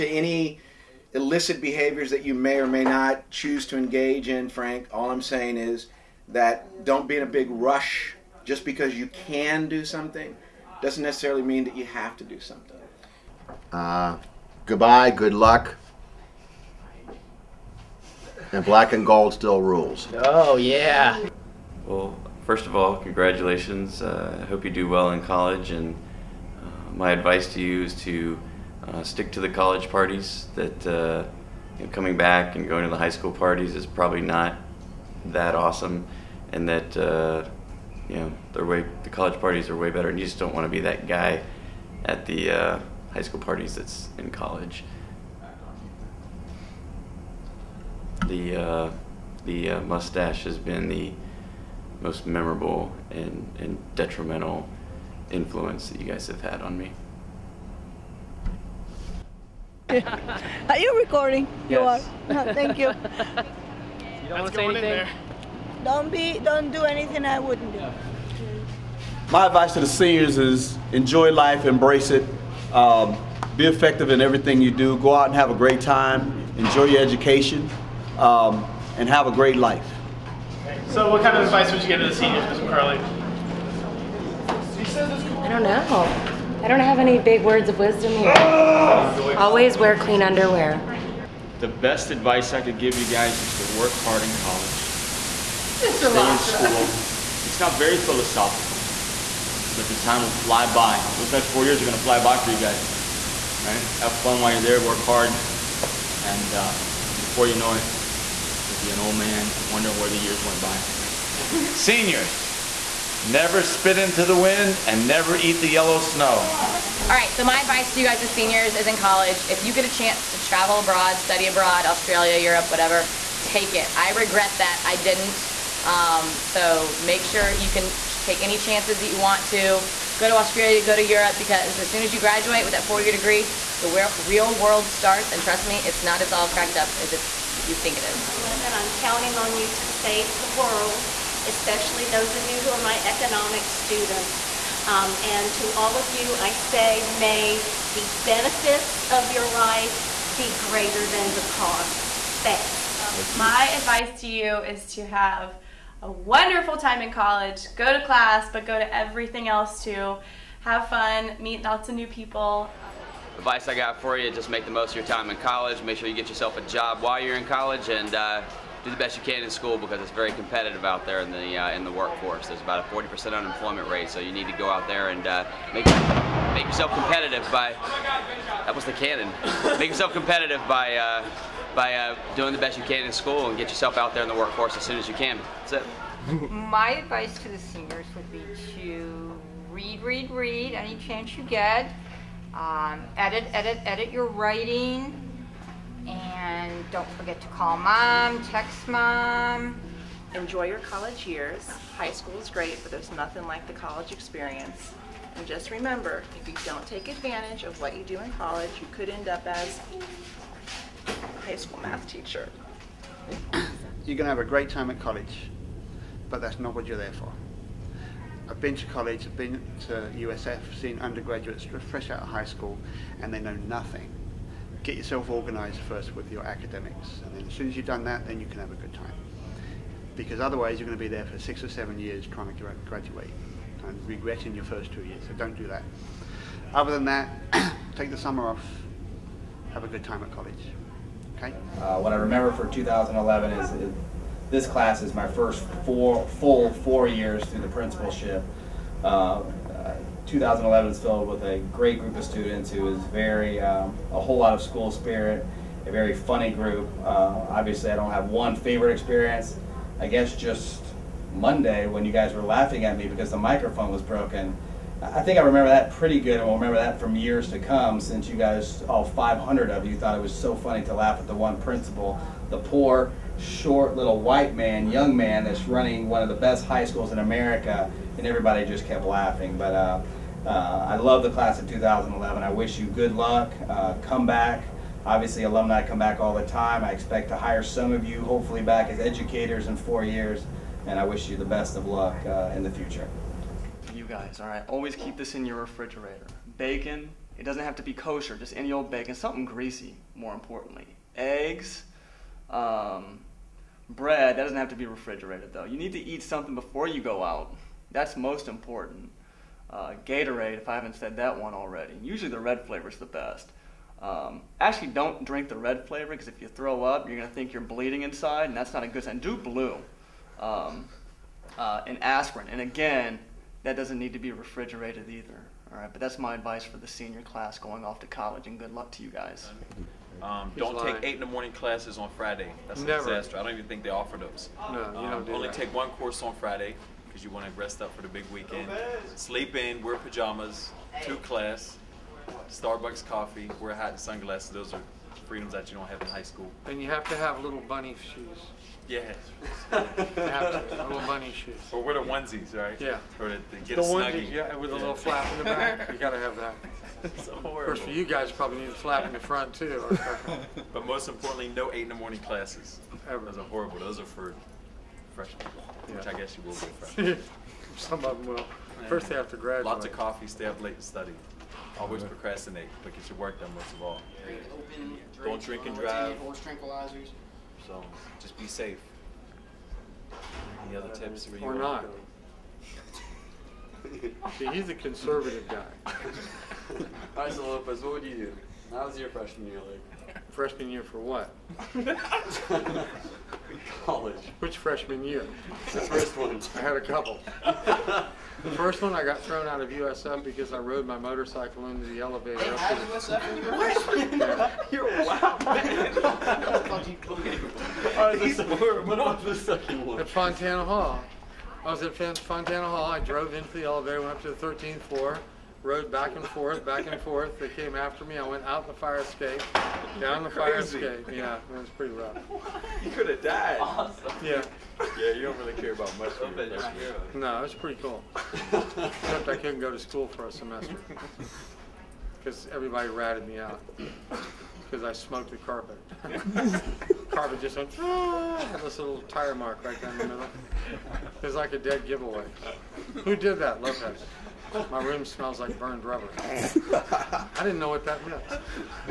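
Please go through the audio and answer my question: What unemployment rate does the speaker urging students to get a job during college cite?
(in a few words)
40%.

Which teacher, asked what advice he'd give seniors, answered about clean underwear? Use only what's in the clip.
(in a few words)
Mr. McCurley.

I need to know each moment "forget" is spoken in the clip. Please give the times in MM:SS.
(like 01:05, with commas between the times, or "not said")
03:17.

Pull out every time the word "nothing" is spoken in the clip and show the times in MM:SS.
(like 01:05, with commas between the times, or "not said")
03:23, 03:43.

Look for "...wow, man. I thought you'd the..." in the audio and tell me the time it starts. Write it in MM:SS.
06:45.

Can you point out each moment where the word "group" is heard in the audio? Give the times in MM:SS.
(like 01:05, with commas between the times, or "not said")
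04:11, 04:16.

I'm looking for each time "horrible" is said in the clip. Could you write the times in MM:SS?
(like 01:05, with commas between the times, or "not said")
06:03.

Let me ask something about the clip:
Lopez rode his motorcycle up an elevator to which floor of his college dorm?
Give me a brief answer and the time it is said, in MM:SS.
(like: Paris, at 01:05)
13th floor, at 06:54.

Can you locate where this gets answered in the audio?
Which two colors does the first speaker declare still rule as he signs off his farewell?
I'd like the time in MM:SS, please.
00:18.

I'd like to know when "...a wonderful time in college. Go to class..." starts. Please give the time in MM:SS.
02:36.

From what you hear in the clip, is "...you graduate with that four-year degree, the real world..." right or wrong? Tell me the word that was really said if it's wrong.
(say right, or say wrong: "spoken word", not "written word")
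right.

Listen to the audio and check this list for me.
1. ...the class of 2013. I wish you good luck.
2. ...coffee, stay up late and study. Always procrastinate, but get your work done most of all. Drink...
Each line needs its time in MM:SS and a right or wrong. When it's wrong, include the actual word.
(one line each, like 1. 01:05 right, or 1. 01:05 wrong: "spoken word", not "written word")
1. 04:41 wrong: "2011", not "2013"
2. 06:09 right.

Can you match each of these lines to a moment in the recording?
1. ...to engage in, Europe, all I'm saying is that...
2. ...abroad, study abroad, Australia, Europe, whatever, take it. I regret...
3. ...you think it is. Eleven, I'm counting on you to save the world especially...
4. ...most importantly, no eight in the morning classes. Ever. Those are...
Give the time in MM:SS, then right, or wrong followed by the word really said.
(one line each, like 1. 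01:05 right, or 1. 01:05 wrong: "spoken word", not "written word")
1. 00:03 wrong: "Frank", not "Europe"
2. 02:00 right
3. 02:17 right
4. 06:00 right.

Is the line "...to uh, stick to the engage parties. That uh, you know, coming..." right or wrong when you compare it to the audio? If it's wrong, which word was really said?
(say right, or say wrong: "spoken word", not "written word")
wrong: "college", not "engage".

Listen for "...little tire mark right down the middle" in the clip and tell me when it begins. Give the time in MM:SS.
07:18.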